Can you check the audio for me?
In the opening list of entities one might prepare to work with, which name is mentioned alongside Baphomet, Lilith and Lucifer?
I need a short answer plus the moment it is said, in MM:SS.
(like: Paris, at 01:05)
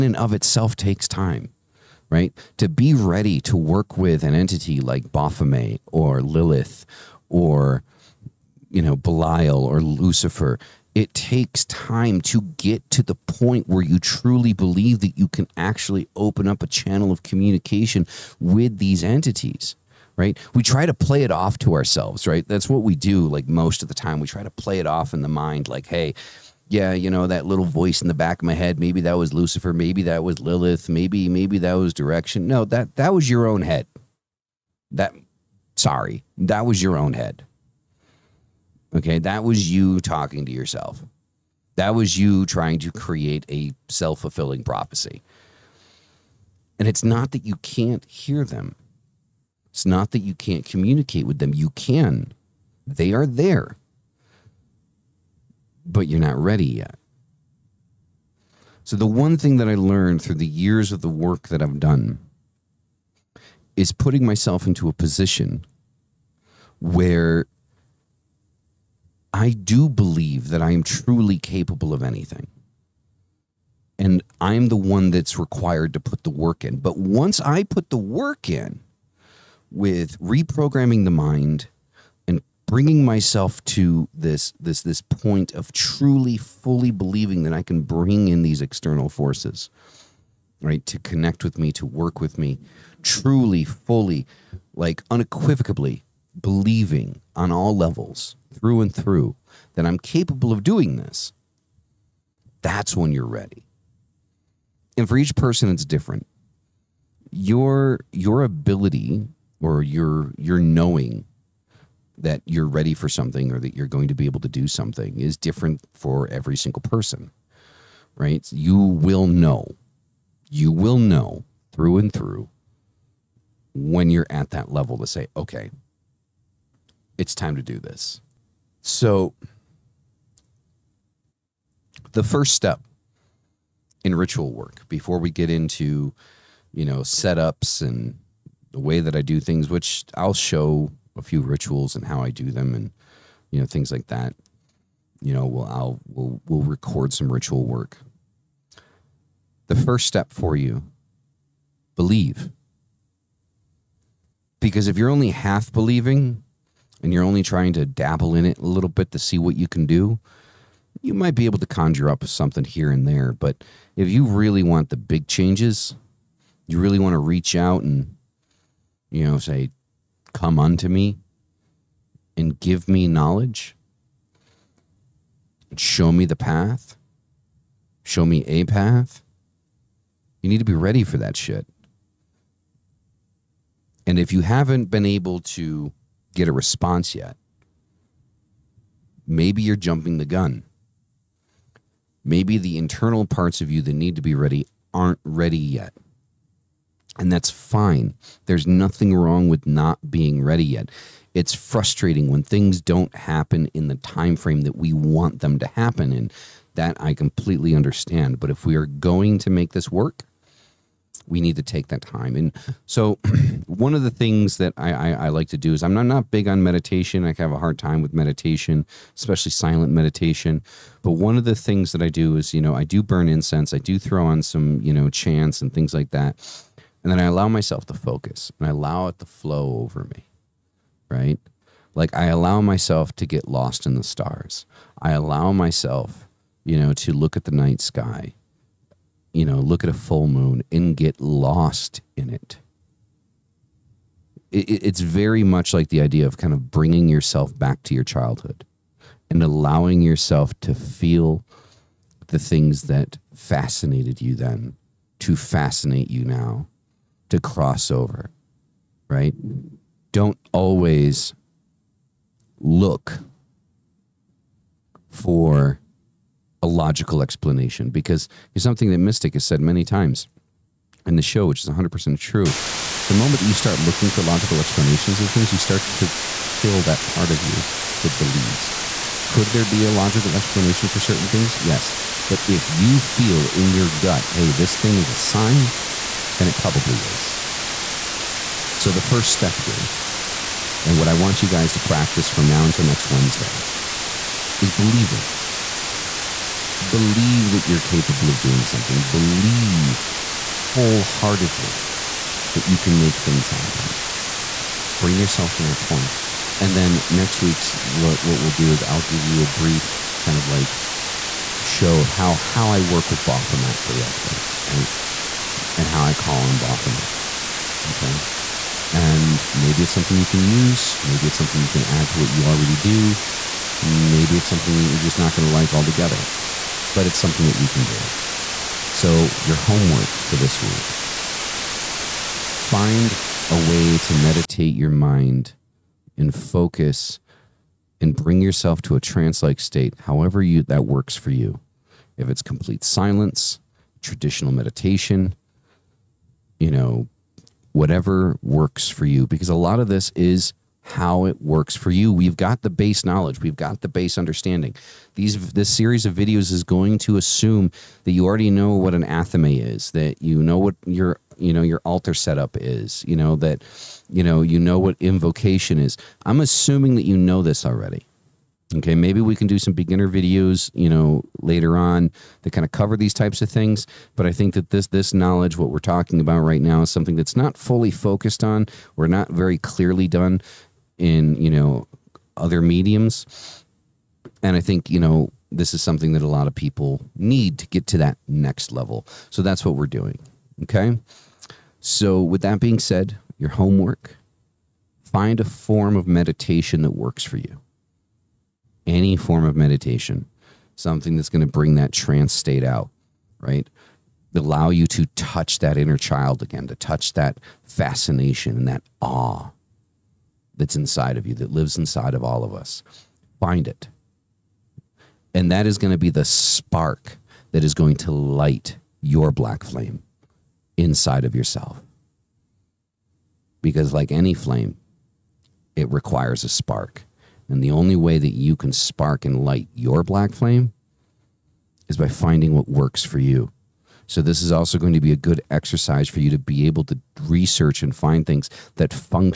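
Belial, at 00:08.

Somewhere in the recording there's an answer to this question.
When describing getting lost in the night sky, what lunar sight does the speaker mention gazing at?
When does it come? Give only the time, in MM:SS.
03:59.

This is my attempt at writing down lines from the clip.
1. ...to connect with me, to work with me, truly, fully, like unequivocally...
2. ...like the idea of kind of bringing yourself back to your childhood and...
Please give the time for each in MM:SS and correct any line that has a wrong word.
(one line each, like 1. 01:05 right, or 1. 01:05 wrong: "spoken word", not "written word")
1. 01:30 right
2. 04:05 right.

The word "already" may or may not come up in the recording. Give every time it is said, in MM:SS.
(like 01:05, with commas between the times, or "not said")
05:22, 05:58, 06:07.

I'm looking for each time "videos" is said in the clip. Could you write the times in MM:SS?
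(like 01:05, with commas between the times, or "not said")
05:56, 06:10.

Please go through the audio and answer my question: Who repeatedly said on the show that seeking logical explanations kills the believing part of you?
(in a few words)
Mystic.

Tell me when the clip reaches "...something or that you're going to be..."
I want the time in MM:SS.
01:53.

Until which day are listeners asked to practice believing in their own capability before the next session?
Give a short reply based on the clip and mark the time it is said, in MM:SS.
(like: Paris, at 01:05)
Next Wednesday, at 04:52.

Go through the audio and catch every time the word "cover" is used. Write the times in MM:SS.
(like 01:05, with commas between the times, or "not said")
06:12.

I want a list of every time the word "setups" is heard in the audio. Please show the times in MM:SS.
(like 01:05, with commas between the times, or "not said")
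02:16, 06:02.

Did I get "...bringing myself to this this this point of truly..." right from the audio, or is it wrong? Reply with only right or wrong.
right.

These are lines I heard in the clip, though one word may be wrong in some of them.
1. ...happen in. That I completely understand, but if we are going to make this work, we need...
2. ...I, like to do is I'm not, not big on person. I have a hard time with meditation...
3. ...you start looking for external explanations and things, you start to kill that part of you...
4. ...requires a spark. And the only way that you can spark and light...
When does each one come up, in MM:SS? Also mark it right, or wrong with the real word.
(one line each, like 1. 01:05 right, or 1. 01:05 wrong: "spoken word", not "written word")
1. 03:25 right
2. 03:35 wrong: "meditation", not "person"
3. 04:33 wrong: "logical", not "external"
4. 07:05 right.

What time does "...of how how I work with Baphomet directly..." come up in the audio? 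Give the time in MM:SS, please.
05:11.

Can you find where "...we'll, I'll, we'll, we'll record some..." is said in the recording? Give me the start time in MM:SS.
02:25.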